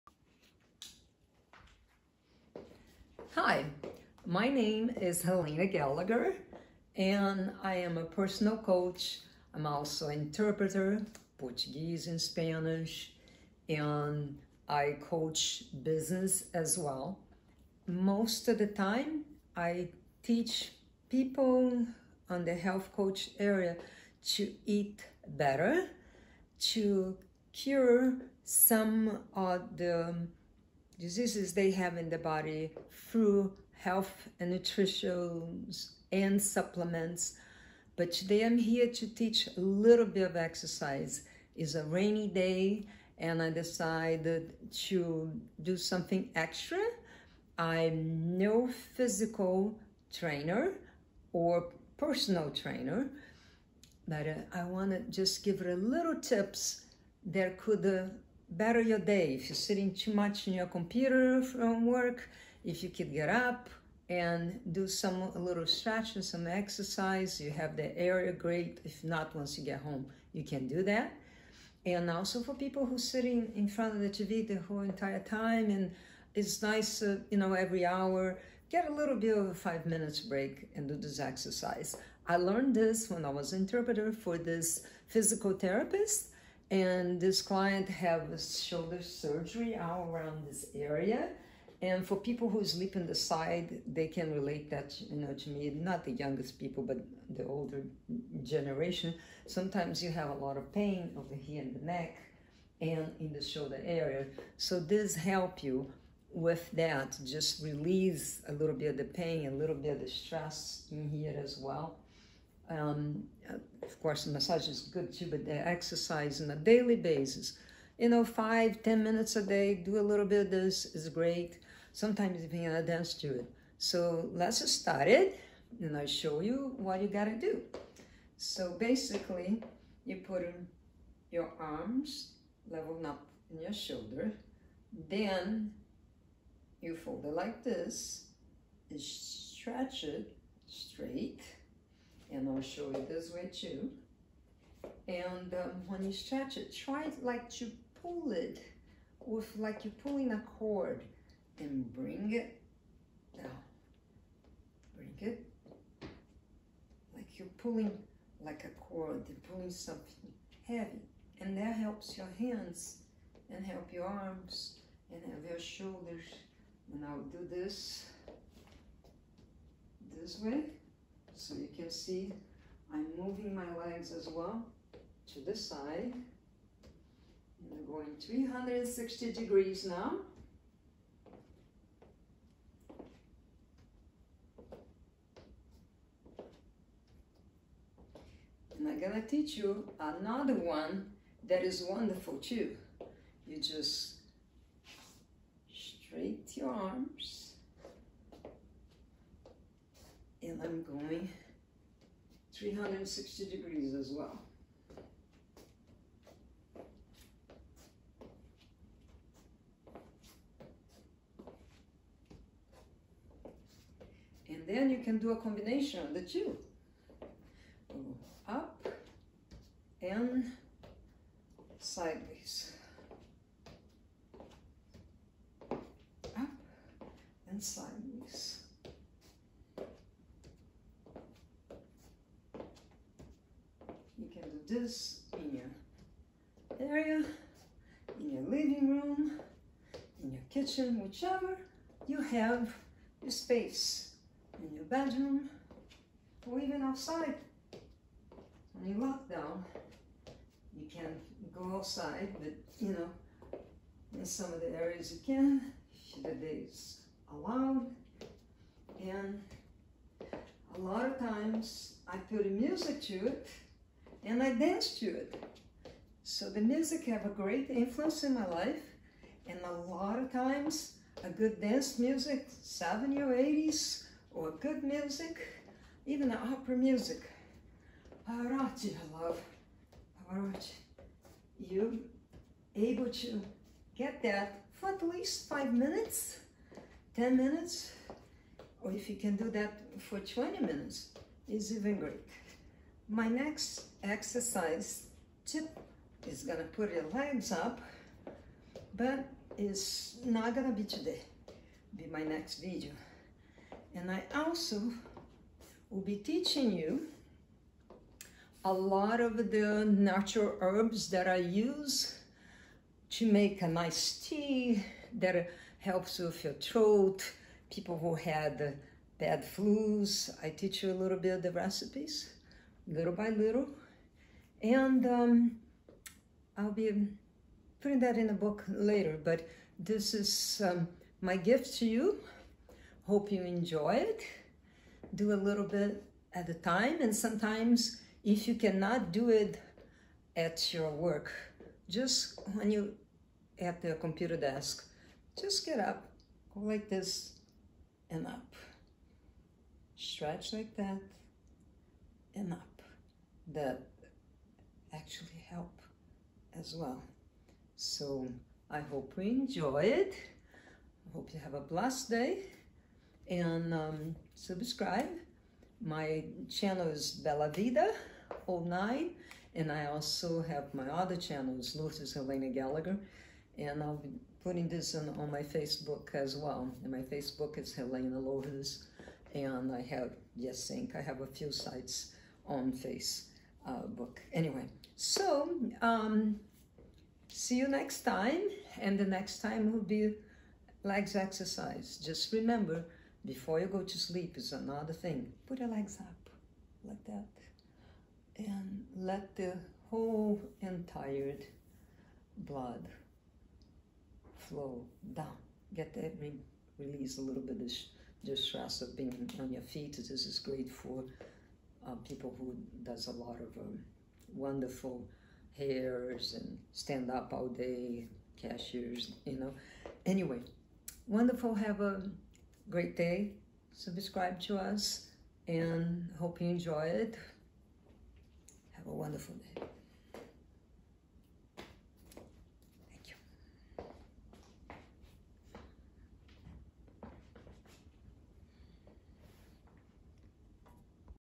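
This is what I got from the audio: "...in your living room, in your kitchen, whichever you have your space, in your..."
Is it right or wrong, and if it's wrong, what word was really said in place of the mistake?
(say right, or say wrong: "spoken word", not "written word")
right.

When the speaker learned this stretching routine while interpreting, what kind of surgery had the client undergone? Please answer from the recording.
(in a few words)
Shoulder surgery.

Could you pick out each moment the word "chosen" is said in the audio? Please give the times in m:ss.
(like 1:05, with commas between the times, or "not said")
not said.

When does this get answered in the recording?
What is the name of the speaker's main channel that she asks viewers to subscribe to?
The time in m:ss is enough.
6:07.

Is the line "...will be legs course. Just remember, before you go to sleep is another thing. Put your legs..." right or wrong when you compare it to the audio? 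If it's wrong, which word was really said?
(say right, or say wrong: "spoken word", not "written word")
wrong: "exercise", not "course".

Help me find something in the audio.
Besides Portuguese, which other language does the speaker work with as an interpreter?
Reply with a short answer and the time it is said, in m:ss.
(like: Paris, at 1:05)
Spanish, at 0:12.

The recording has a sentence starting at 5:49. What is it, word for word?
Stretch like that and up that actually help as well.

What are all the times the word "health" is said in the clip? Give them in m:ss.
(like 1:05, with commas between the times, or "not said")
0:22, 0:33.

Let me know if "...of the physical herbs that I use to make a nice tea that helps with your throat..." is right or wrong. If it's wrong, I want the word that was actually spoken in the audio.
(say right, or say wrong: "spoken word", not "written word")
wrong: "natural", not "physical".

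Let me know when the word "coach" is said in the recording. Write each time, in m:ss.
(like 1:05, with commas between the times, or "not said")
0:08, 0:14, 0:22.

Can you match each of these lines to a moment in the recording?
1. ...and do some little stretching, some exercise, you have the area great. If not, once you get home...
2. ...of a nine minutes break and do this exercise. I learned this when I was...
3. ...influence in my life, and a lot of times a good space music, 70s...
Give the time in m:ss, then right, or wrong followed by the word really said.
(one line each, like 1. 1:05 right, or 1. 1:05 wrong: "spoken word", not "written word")
1. 1:04 right
2. 1:19 wrong: "five", not "nine"
3. 4:27 wrong: "dance", not "space".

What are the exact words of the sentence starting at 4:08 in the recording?
When you lock down, you can go outside, but you know, in some of the areas you can, the day is allowed.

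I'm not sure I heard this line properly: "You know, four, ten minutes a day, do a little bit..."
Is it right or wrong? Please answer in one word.
wrong.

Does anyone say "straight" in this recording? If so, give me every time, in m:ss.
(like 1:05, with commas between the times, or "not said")
2:20, 3:15.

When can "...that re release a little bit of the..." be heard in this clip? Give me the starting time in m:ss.
6:45.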